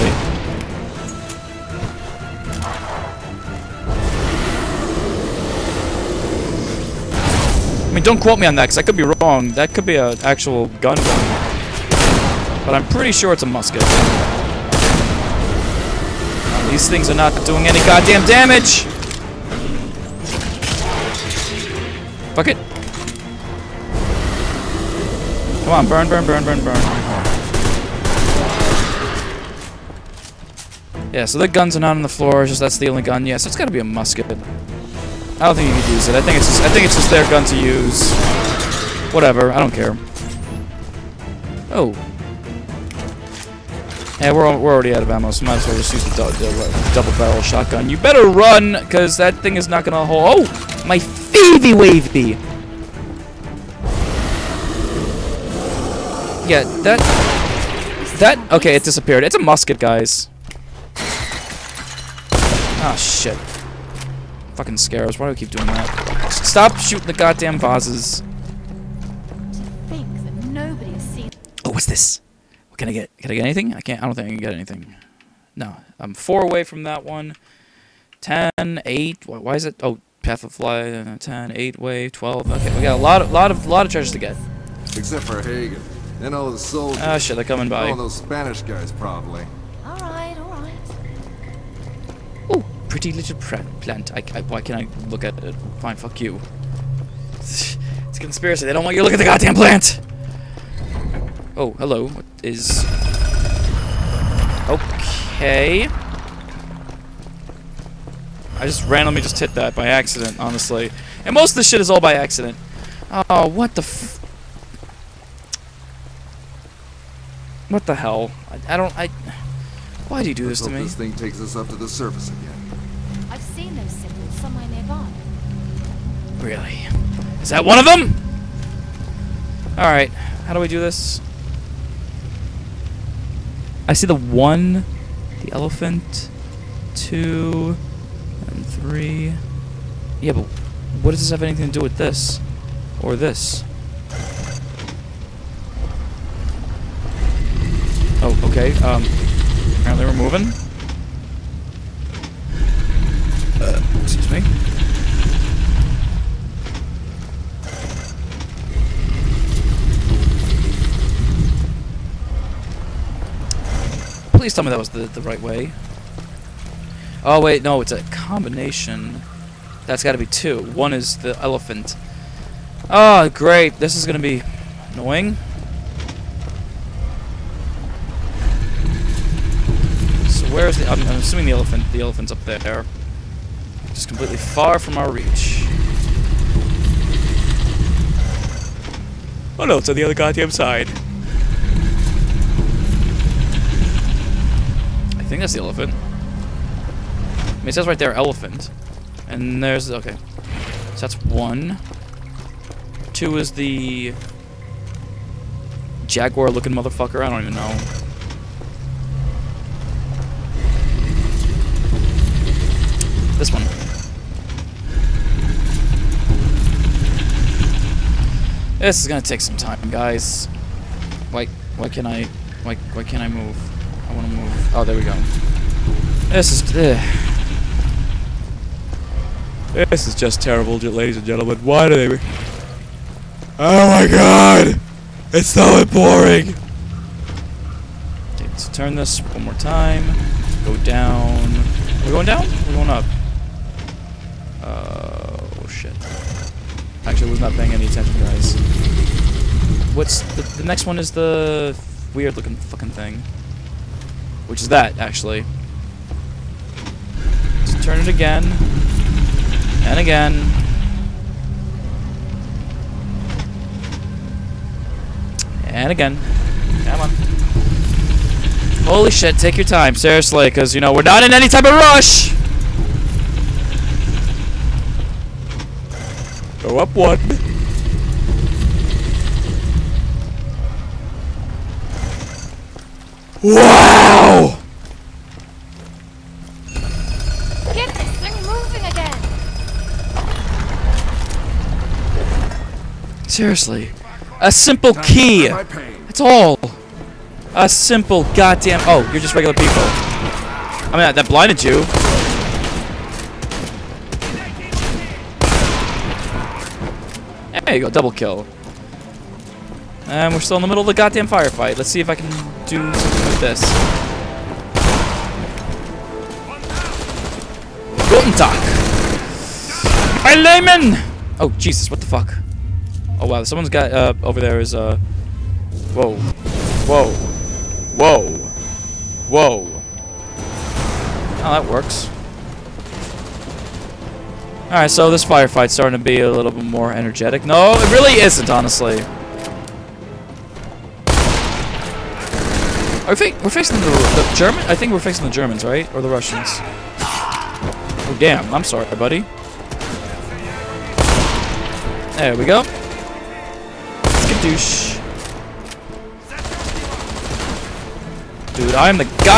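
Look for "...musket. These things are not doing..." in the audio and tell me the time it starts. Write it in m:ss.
0:13.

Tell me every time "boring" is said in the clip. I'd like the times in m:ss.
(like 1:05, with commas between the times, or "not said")
3:55.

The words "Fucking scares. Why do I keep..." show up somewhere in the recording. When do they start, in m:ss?
1:04.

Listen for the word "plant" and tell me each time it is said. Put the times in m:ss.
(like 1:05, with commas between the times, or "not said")
1:33, 1:39.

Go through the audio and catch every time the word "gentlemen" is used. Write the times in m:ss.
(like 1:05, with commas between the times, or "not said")
3:51.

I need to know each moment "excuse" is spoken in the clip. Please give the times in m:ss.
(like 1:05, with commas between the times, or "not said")
2:34.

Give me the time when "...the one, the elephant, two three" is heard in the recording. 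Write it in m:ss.
2:14.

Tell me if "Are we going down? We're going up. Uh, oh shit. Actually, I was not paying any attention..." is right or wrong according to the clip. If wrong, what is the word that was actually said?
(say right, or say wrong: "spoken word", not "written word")
right.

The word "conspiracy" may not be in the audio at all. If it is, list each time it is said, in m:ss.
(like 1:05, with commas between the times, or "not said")
1:38.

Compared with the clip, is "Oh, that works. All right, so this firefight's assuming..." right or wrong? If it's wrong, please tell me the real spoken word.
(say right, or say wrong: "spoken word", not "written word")
wrong: "starting", not "assuming".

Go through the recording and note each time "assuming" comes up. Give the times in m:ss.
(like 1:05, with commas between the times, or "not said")
3:01.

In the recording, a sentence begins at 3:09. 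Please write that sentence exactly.
Oh no, it's on the other goddamn side.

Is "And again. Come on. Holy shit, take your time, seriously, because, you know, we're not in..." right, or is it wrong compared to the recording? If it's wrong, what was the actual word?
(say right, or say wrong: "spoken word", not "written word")
right.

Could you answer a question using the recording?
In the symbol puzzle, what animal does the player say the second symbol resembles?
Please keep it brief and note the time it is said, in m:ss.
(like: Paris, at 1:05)
jaguar, at 3:26.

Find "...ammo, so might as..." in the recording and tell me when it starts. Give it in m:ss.
0:45.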